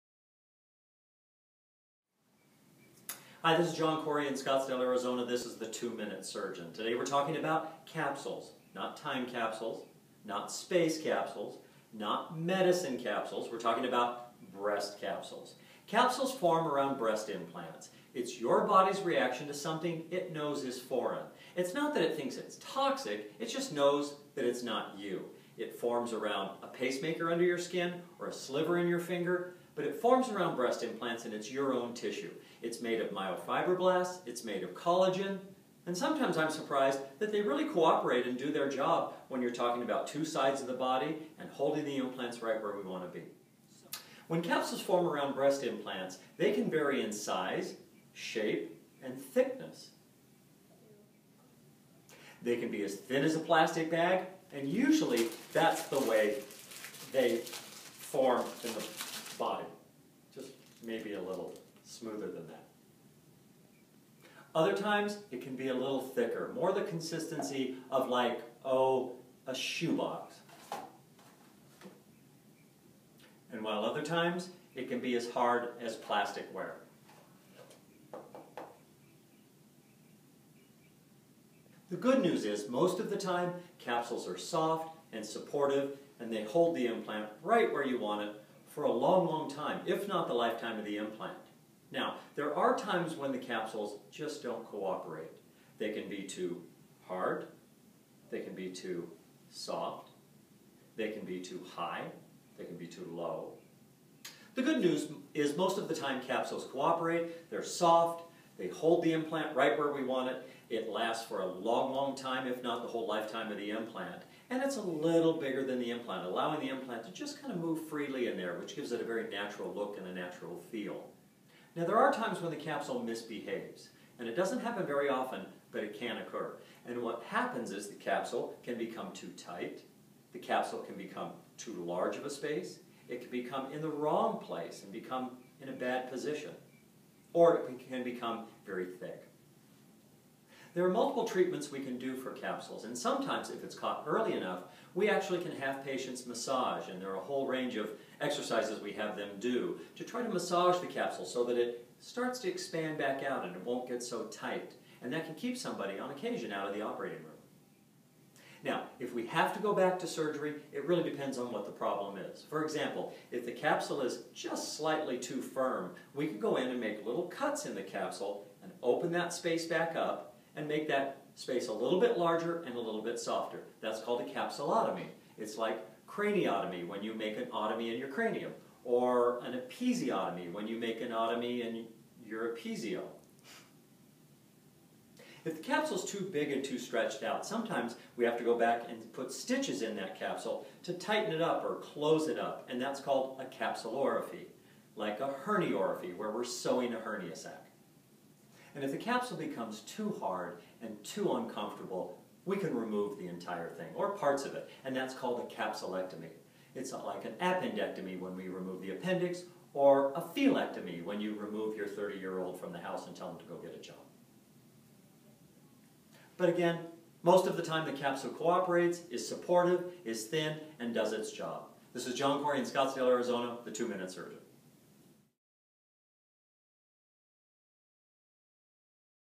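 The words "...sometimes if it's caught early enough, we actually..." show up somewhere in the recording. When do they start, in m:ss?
2:22.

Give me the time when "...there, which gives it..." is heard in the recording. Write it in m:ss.
1:58.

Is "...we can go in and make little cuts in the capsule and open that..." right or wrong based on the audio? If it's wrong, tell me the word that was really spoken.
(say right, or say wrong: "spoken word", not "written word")
right.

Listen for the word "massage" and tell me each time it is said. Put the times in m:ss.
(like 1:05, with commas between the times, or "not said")
2:26, 2:30.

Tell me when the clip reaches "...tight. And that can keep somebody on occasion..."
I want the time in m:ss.
2:34.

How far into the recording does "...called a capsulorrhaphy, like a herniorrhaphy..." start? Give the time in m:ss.
3:12.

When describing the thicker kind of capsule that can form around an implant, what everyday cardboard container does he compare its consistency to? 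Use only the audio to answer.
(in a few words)
a shoebox.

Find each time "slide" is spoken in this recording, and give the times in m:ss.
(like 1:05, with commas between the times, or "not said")
not said.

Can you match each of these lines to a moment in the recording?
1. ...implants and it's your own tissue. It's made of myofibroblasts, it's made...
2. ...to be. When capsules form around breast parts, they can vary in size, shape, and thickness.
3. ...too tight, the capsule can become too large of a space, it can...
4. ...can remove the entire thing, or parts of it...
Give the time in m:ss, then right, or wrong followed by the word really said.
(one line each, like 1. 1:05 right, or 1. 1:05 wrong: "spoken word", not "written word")
1. 0:30 right
2. 0:43 wrong: "implants", not "parts"
3. 2:09 right
4. 3:22 right.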